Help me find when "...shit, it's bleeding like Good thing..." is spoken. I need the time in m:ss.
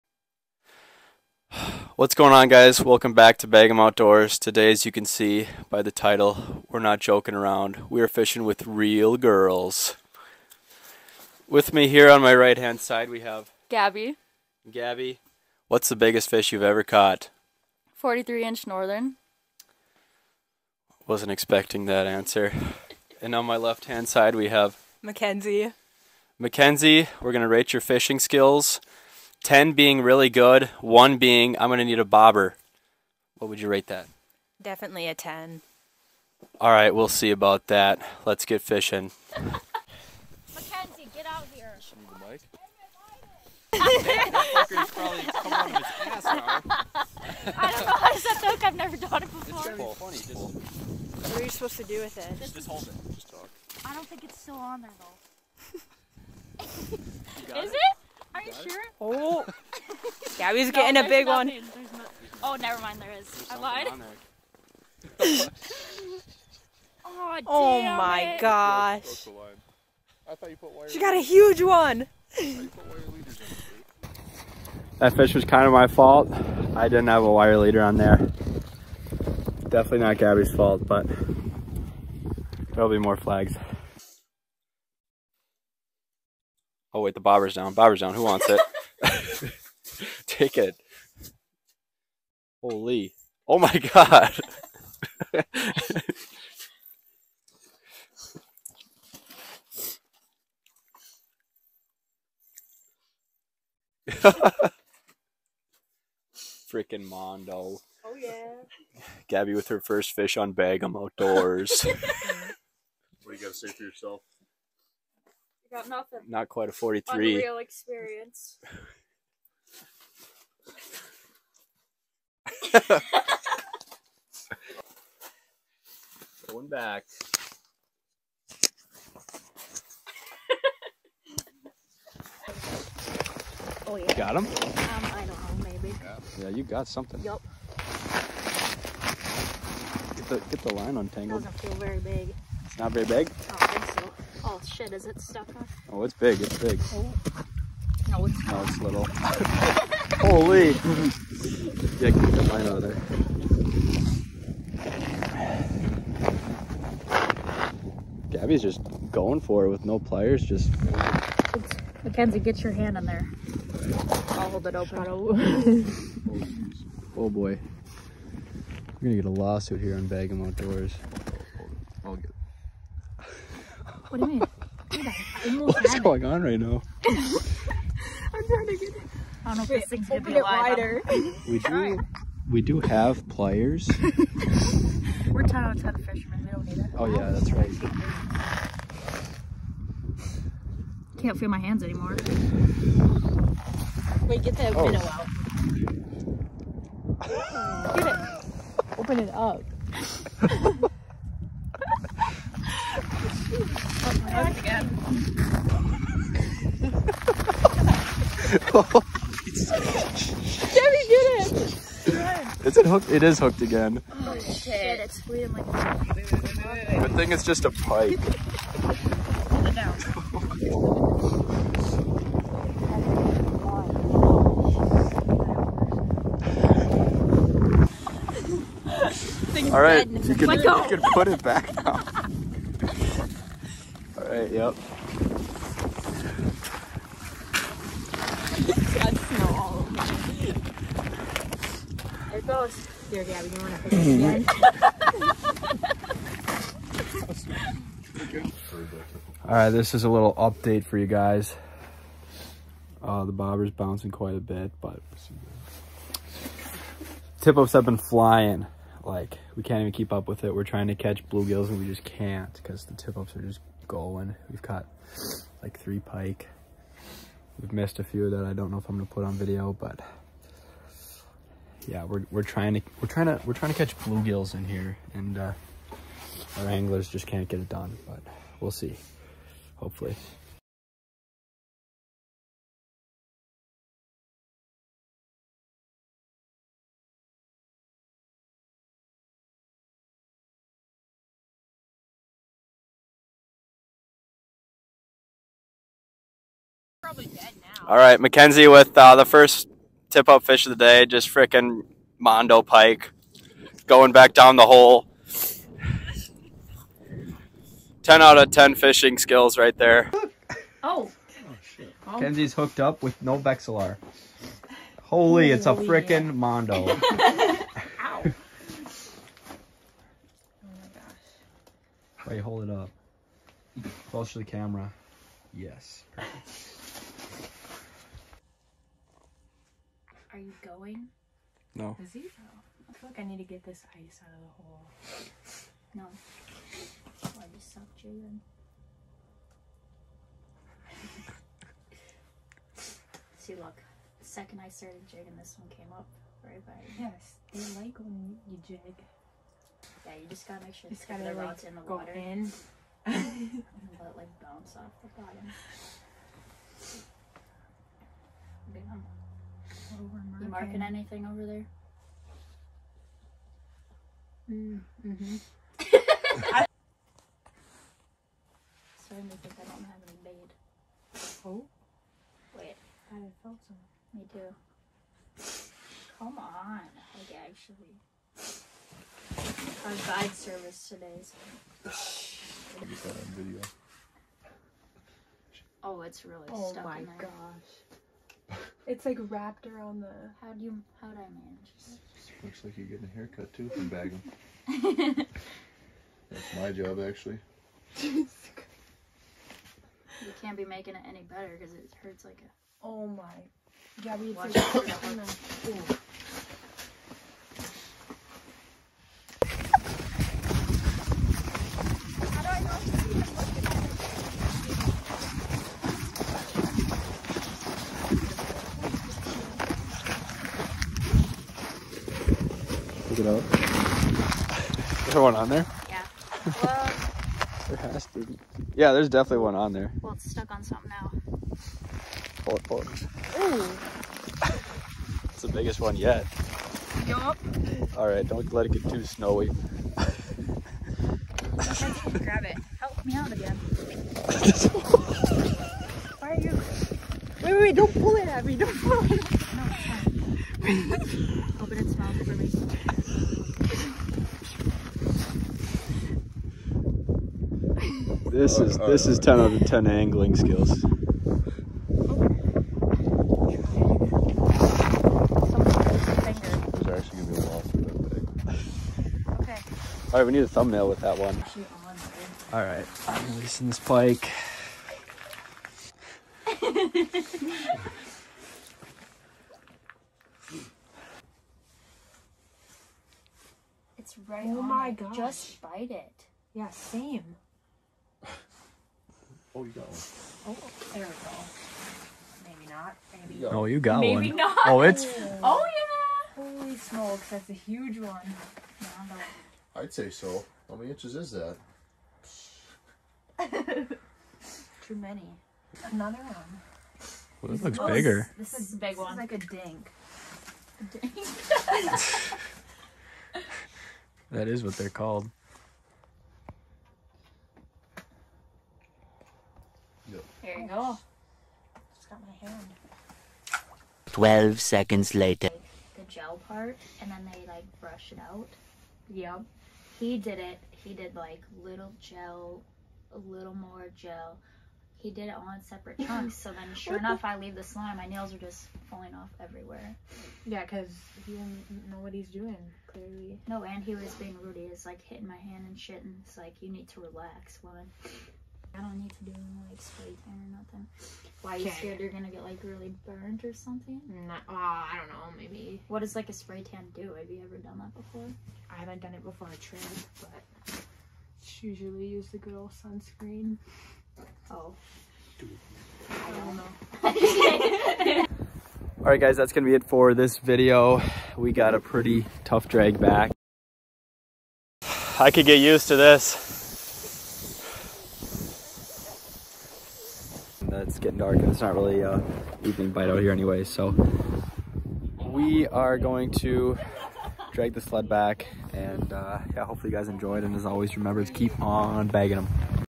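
3:34.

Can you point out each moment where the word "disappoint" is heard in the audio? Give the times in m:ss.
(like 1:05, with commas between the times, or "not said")
not said.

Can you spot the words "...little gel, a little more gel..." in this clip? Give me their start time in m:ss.
8:51.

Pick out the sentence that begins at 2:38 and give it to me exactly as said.
Gabby's just going for it with no pliers, just...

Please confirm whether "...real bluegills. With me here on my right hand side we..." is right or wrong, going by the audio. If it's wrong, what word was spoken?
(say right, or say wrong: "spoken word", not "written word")
wrong: "girls", not "bluegills".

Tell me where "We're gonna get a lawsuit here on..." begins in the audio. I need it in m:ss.
2:49.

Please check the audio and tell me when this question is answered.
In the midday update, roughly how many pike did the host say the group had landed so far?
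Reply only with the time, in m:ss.
4:25.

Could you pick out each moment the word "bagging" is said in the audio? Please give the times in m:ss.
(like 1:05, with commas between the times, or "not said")
6:33, 9:52.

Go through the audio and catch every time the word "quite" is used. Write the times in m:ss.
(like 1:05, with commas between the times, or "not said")
1:56, 4:14.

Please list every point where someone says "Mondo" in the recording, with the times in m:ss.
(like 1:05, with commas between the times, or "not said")
1:47, 5:02, 5:16.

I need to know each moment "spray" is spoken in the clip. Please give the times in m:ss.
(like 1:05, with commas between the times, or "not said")
9:09, 9:16.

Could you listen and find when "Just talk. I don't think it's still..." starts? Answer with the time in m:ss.
0:53.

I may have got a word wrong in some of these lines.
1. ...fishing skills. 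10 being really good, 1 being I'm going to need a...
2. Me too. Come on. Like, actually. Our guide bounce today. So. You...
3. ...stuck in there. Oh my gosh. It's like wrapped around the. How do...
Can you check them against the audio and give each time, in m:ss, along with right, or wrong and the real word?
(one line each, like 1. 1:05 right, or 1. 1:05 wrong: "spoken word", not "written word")
1. 0:27 right
2. 6:14 wrong: "service", not "bounce"
3. 6:26 right.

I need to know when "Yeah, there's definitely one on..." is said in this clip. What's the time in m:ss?
7:08.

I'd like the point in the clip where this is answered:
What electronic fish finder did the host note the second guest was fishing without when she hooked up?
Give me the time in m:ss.
5:13.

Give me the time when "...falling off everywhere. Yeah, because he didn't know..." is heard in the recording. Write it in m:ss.
8:58.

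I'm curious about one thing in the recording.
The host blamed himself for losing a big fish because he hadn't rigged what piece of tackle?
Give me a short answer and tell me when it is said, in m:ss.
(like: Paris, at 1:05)
wire leader, at 1:17.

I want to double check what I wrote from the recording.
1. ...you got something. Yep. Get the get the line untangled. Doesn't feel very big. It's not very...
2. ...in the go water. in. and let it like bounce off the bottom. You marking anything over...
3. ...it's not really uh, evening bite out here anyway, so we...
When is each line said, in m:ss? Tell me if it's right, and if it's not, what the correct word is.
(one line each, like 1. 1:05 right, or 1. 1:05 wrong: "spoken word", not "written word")
1. 2:16 right
2. 5:51 right
3. 9:41 right.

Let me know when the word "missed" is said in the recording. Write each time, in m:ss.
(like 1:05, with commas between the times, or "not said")
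4:27.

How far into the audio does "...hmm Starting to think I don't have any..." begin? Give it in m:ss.
6:05.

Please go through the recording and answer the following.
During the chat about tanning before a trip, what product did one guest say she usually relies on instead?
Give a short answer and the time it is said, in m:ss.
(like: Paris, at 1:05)
sunscreen, at 9:22.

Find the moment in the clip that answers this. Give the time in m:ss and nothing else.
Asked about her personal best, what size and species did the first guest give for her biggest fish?
0:17.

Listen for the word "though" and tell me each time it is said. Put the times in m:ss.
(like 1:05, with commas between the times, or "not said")
0:54.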